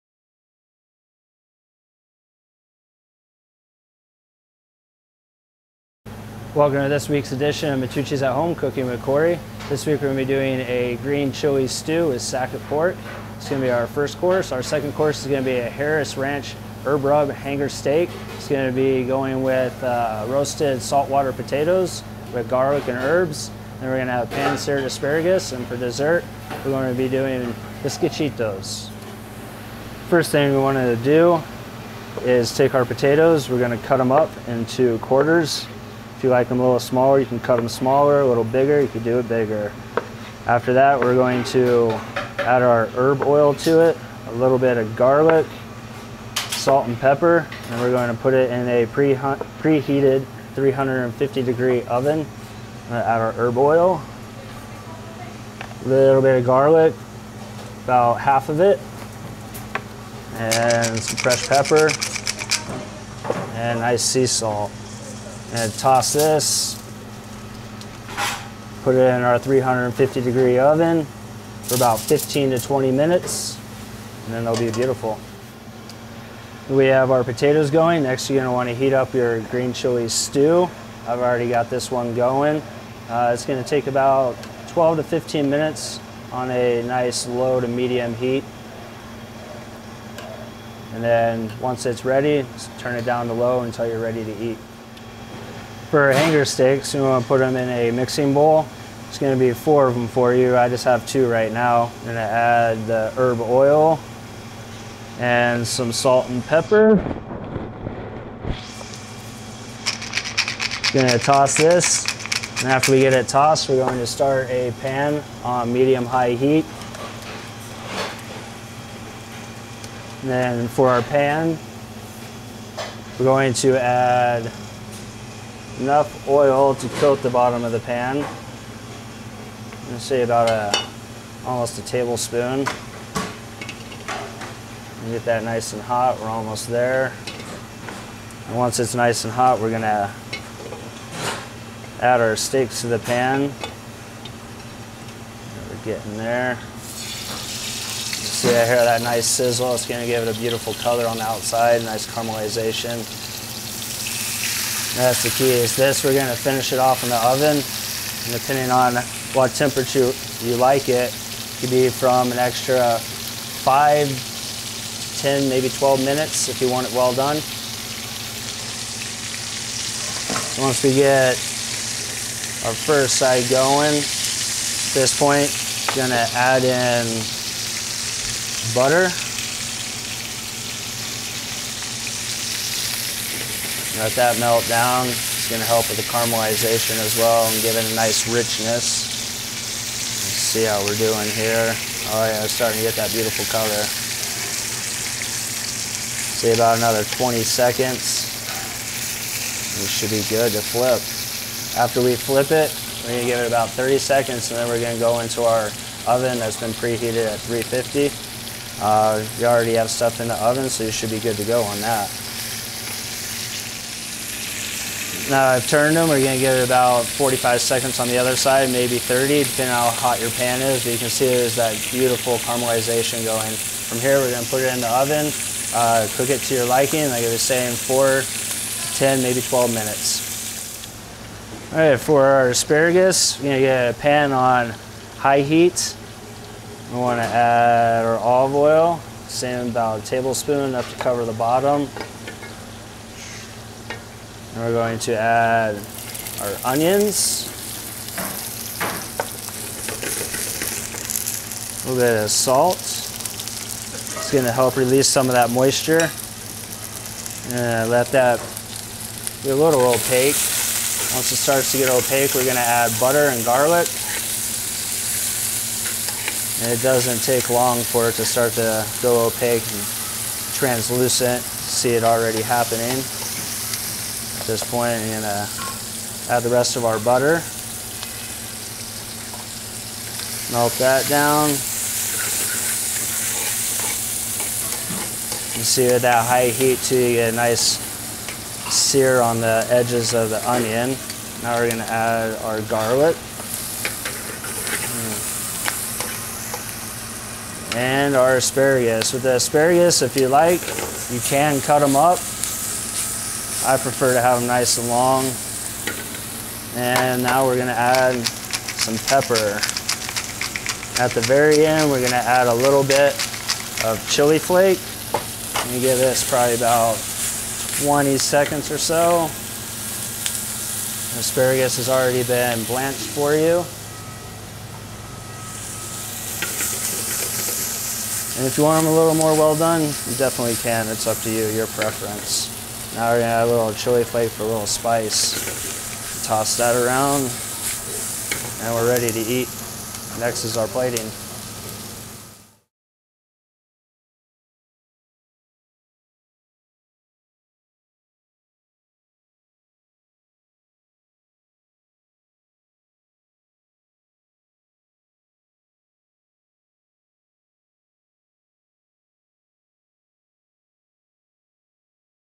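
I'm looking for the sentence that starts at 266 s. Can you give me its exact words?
And it doesn't take long for it to start to go opaque and translucent.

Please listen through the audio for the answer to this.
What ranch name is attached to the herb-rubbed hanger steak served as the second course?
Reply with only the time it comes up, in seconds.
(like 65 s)
15 s.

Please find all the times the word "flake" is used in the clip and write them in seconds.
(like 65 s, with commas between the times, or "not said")
314 s, 334 s.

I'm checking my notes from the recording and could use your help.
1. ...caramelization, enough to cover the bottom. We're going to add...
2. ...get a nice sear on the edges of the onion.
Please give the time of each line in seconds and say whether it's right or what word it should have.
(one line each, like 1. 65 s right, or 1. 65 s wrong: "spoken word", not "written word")
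1. 240 s wrong: "tablespoon", not "caramelization"
2. 287 s right.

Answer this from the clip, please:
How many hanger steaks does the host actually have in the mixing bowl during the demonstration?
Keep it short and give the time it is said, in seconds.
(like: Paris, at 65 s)
2, at 101 s.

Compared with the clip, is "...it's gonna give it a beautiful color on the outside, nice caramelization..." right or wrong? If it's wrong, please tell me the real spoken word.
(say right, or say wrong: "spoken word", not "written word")
right.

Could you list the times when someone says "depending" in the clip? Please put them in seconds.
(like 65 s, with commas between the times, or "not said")
158 s, 219 s.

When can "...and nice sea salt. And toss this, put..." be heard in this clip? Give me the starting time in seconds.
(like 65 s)
63 s.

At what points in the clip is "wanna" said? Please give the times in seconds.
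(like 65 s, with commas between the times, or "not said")
78 s, 236 s.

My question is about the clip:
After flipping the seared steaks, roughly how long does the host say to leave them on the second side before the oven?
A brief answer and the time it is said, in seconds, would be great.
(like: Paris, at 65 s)
45 seconds, at 217 s.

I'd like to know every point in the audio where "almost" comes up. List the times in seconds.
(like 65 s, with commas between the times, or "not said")
131 s, 136 s.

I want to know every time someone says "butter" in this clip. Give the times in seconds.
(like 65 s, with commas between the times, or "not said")
178 s, 262 s, 276 s.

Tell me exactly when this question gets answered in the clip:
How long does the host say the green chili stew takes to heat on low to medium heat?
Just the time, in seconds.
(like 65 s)
84 s.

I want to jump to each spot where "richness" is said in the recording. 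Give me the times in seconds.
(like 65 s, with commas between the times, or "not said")
188 s.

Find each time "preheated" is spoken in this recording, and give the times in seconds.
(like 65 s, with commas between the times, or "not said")
48 s, 206 s.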